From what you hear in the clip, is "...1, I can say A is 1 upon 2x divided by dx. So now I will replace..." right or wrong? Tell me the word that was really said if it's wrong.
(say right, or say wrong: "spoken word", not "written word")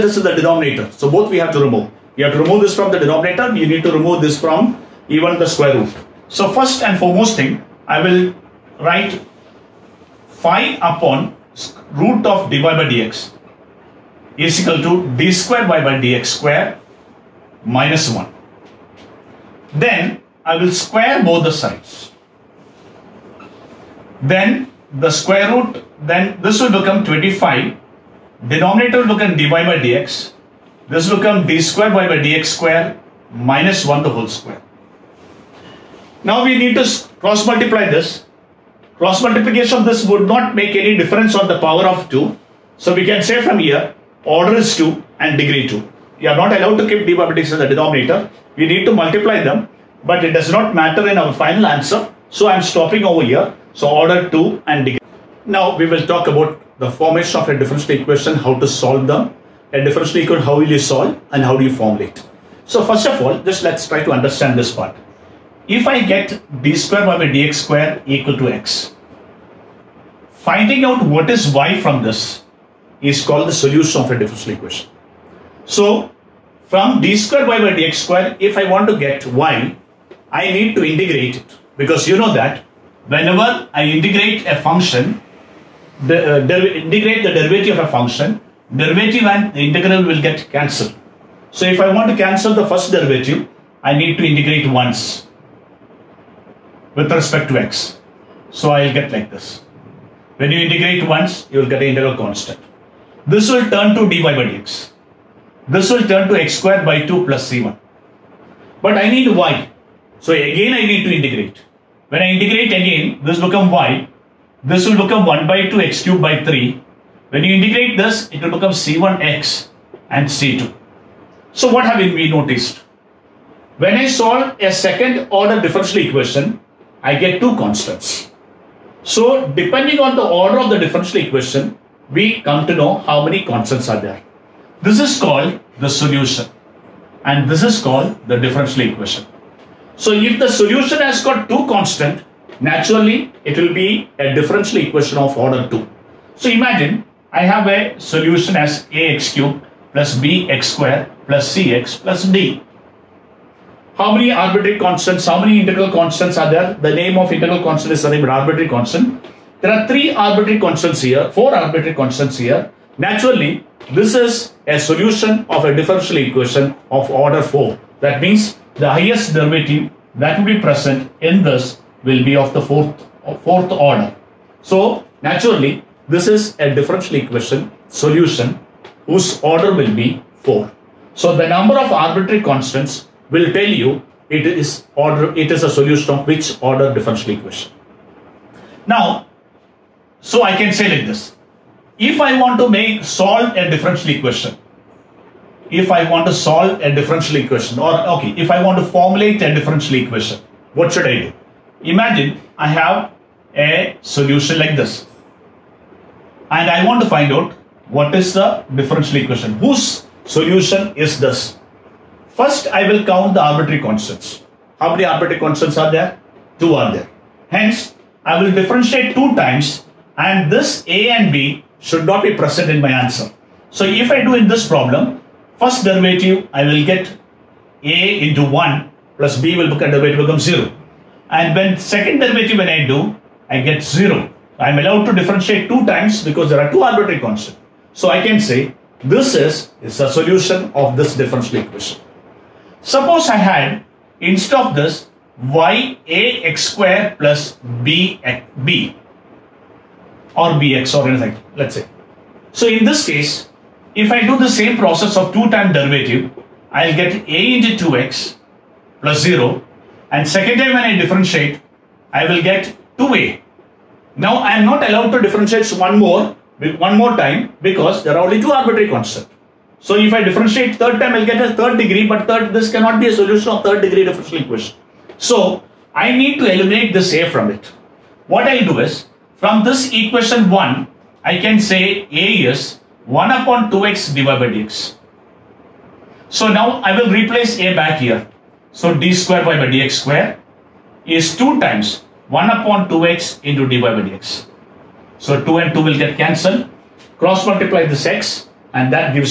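right.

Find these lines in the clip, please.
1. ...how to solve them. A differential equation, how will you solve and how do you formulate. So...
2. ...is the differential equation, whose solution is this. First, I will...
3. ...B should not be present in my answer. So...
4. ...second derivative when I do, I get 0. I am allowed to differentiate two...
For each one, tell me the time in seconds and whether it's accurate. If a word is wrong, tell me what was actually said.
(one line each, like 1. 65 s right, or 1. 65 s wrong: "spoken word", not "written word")
1. 58 s right
2. 208 s right
3. 221 s right
4. 231 s right.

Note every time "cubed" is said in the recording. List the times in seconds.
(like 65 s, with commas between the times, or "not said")
116 s, 149 s.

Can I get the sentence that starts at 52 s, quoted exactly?
So I am stopping over here.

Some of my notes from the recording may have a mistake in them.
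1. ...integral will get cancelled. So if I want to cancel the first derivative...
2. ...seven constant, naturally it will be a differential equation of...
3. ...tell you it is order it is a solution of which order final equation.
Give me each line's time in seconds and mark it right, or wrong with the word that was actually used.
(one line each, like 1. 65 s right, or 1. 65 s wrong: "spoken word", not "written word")
1. 89 s right
2. 141 s wrong: "two", not "seven"
3. 183 s wrong: "differential", not "final".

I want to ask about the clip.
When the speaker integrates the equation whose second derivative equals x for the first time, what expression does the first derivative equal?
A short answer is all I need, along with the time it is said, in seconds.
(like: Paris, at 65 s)
x square by 2 plus c1, at 106 s.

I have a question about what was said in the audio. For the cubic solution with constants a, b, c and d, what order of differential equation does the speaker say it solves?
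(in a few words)
4.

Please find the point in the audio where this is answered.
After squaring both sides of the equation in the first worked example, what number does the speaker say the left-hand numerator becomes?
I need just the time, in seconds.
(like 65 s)
27 s.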